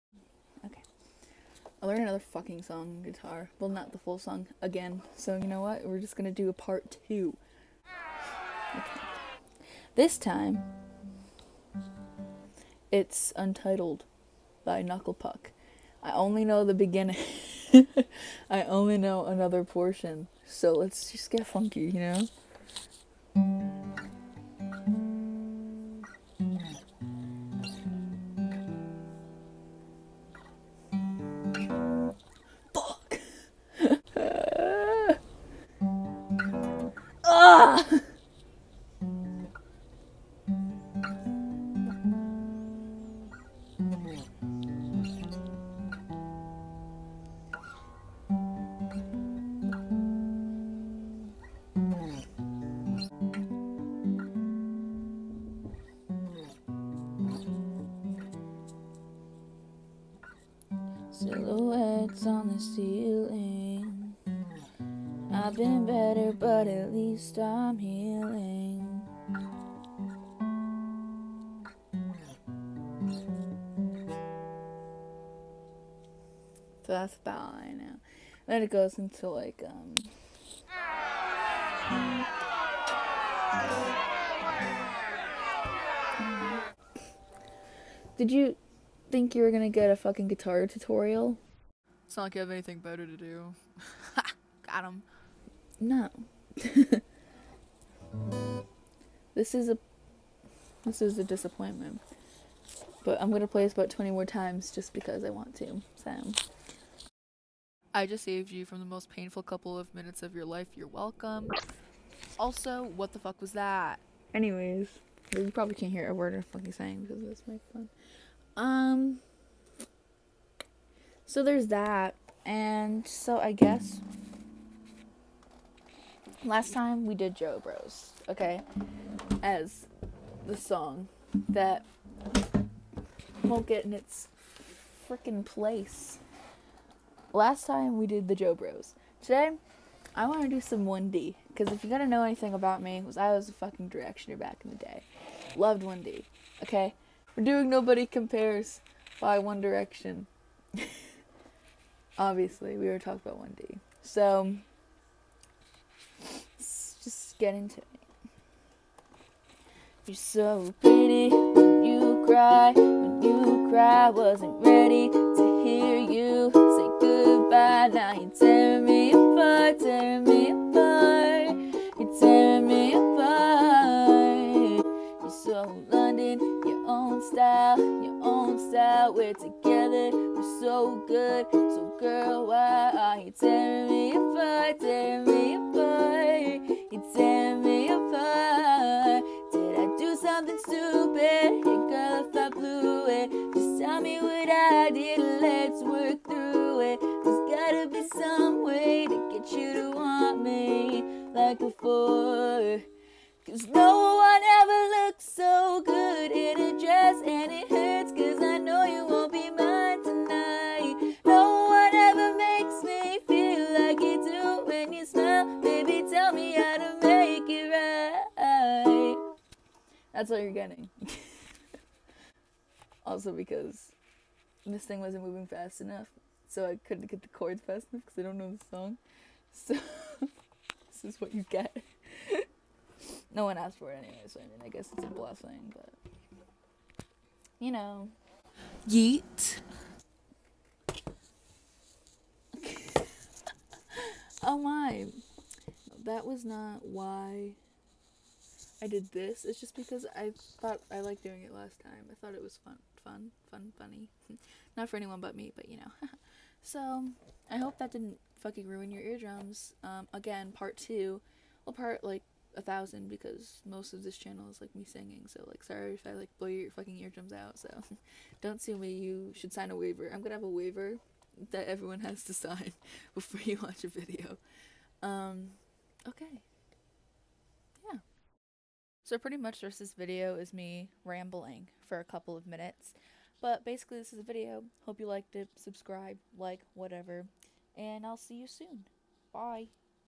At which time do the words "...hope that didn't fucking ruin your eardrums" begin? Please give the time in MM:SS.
04:17.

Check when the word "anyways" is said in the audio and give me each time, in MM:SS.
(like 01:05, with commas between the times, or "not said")
01:54, 03:53.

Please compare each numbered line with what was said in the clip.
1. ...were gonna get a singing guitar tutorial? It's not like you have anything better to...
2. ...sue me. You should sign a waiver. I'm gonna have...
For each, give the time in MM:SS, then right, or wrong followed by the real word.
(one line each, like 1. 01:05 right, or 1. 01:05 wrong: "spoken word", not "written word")
1. 01:29 wrong: "fucking", not "singing"
2. 04:28 right.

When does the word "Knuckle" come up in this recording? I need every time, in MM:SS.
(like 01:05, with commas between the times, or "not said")
00:14.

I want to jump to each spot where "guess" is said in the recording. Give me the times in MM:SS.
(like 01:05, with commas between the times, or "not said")
02:03, 03:54.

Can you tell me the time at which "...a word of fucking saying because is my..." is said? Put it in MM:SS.
01:56.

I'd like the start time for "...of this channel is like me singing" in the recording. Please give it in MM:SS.
04:23.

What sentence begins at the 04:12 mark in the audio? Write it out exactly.
I thought it was fun, fun, fun, funny.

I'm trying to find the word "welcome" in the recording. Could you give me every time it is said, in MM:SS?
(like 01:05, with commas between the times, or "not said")
01:50.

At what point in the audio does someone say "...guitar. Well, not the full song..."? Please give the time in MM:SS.
00:03.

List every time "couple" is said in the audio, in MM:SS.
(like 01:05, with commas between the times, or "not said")
01:49, 04:42.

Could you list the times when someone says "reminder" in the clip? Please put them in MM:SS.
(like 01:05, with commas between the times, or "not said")
not said.